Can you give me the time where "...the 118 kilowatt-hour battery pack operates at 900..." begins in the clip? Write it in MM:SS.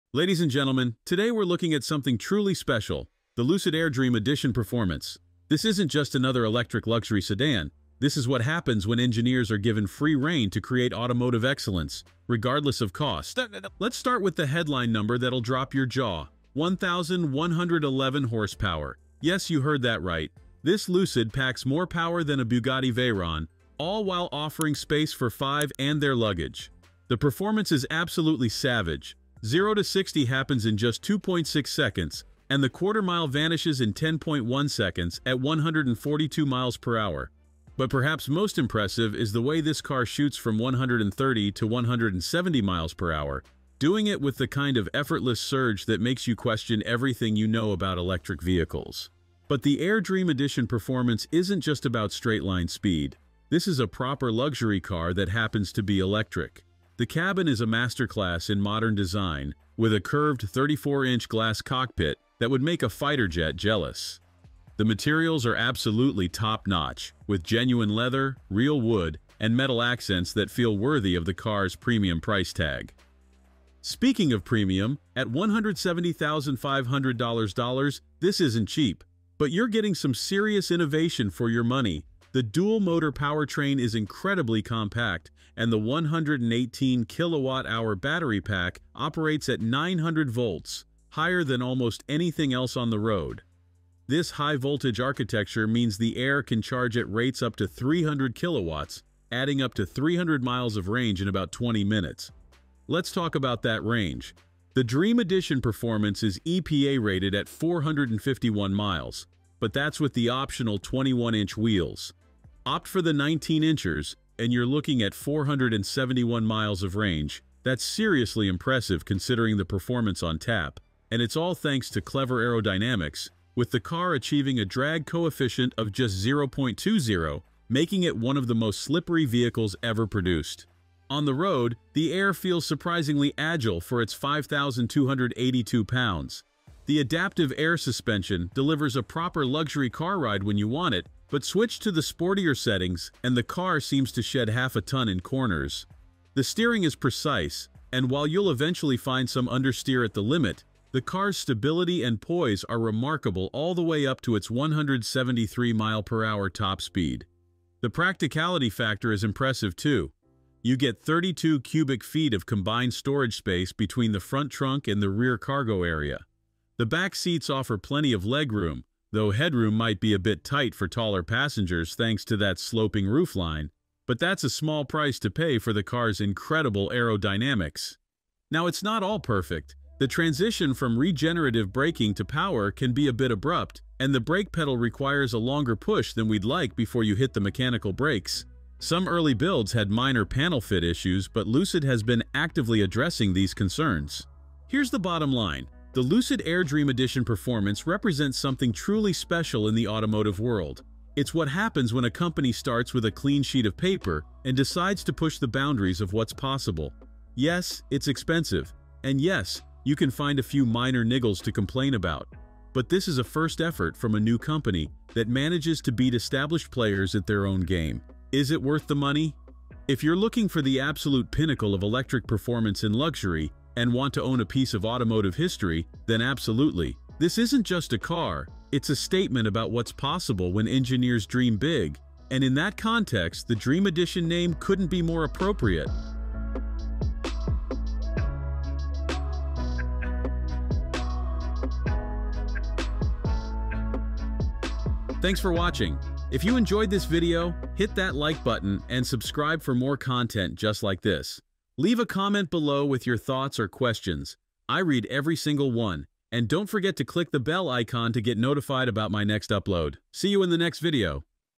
01:25.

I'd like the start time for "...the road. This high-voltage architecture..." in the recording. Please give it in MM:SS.
01:32.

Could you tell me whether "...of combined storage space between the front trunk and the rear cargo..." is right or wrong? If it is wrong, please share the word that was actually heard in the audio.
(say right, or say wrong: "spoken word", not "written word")
right.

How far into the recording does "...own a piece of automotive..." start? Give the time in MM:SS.
03:44.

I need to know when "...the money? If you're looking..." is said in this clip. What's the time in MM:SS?
03:38.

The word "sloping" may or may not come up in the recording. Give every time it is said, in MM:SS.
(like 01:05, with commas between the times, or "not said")
02:52.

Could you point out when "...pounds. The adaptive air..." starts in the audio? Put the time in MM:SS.
02:15.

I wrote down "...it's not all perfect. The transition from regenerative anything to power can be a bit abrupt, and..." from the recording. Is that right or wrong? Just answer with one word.
wrong.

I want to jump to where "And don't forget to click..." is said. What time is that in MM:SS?
04:16.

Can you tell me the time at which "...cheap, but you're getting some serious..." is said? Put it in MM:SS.
01:18.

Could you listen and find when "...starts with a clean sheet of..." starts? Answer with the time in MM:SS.
03:22.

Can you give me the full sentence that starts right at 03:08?
Some early builds had minor panel fit issues, but Lucid has been actively addressing these concerns.